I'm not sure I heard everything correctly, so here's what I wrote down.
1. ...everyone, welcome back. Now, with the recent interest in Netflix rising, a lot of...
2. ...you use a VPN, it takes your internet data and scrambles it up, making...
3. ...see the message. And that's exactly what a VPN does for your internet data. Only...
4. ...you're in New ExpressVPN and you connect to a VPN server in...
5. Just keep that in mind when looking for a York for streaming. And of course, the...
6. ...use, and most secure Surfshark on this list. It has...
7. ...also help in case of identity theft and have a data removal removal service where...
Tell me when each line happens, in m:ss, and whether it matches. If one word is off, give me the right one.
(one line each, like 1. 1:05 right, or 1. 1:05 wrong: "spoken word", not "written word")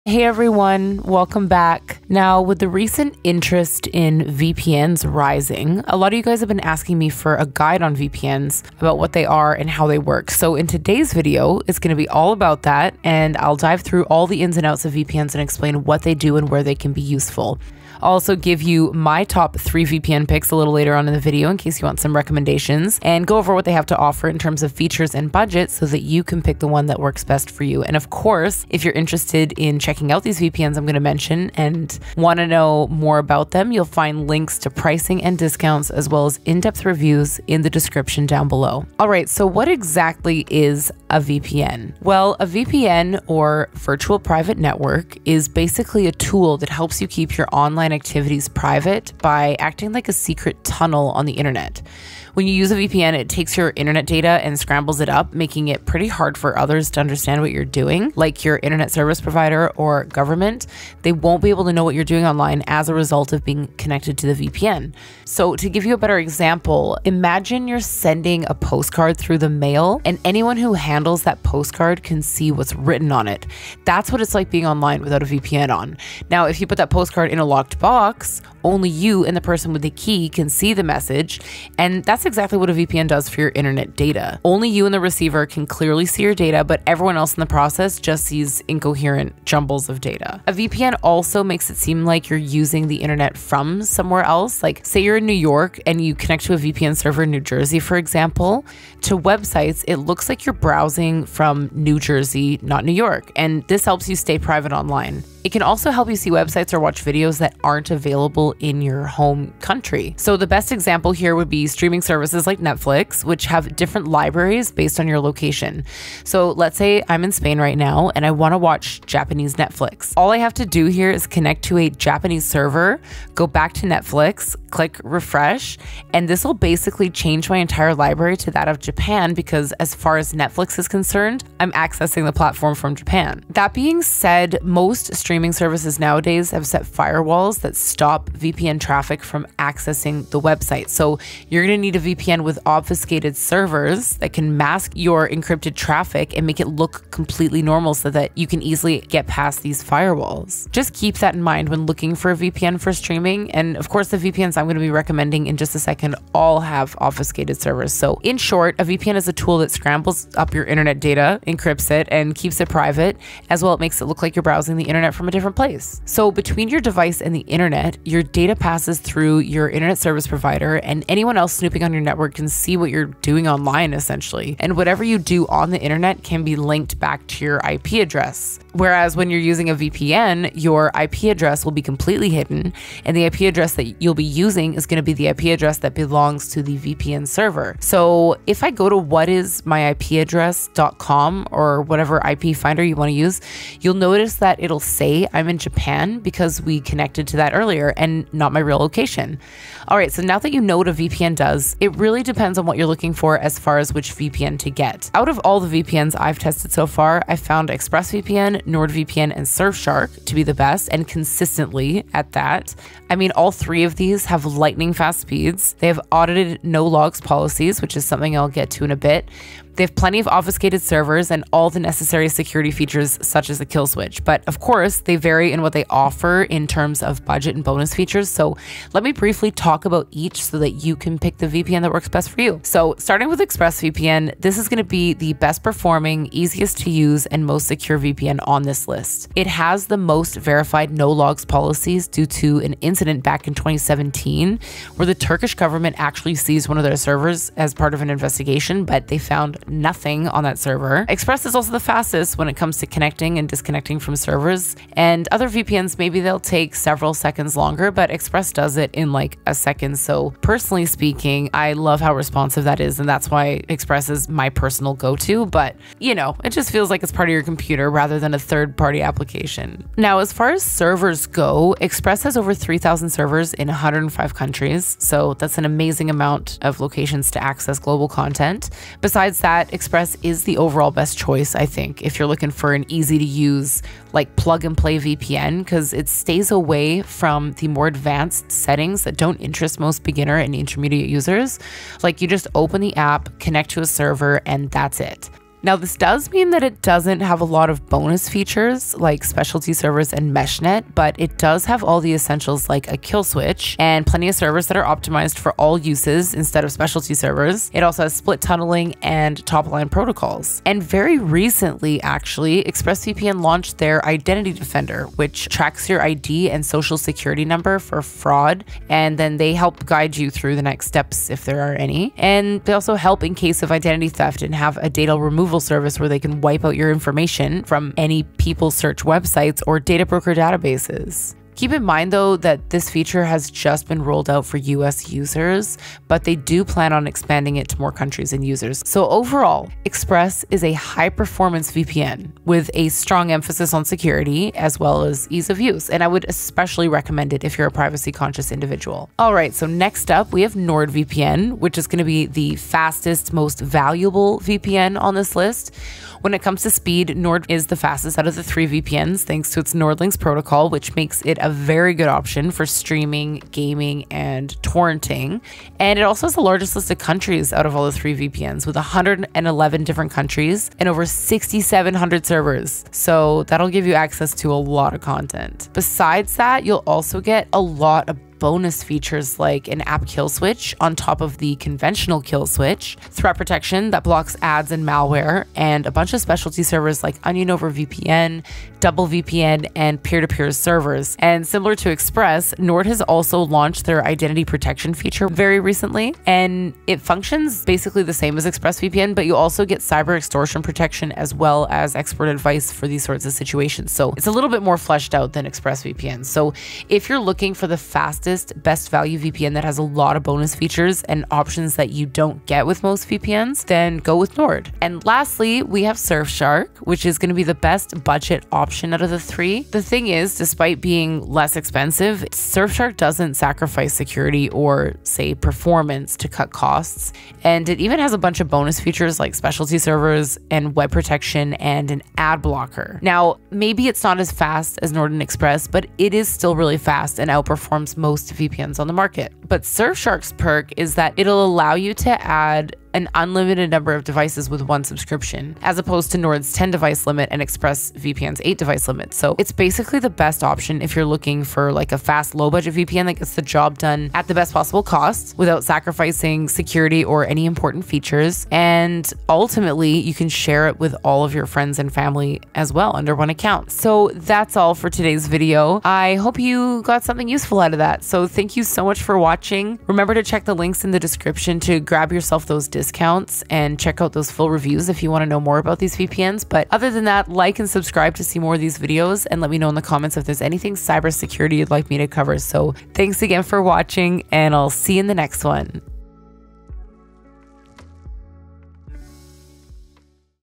1. 0:00 wrong: "VPNs", not "Netflix"
2. 0:52 right
3. 1:20 right
4. 1:35 wrong: "York", not "ExpressVPN"
5. 2:30 wrong: "VPN", not "York"
6. 3:56 wrong: "VPN", not "Surfshark"
7. 5:22 right.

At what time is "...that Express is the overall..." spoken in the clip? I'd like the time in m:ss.
4:39.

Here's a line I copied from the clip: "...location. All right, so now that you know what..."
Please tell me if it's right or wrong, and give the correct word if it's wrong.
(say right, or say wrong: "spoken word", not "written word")
right.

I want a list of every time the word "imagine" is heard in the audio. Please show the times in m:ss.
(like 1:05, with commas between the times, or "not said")
1:07.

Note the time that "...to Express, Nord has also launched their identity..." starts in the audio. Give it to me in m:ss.
6:31.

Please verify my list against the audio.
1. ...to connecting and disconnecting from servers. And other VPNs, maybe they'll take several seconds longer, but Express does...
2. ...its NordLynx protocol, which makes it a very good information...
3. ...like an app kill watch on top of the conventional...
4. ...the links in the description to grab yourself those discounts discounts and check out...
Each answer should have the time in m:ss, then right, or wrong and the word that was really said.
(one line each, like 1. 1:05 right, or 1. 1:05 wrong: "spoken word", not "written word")
1. 4:12 right
2. 5:59 wrong: "option", not "information"
3. 6:19 wrong: "switch", not "watch"
4. 7:50 right.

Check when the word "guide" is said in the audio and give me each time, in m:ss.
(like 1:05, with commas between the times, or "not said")
0:07, 5:19.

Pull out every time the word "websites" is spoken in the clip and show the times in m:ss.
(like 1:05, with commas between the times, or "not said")
1:39, 1:46, 2:20, 5:29.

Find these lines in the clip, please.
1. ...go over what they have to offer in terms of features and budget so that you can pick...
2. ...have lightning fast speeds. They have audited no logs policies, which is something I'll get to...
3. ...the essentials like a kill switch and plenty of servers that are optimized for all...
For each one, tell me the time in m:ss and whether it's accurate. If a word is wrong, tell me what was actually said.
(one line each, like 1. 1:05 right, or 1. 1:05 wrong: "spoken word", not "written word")
1. 0:23 right
2. 3:34 right
3. 5:02 right.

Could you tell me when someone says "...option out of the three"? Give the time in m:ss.
6:58.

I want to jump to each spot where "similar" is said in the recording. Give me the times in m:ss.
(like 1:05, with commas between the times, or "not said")
6:31.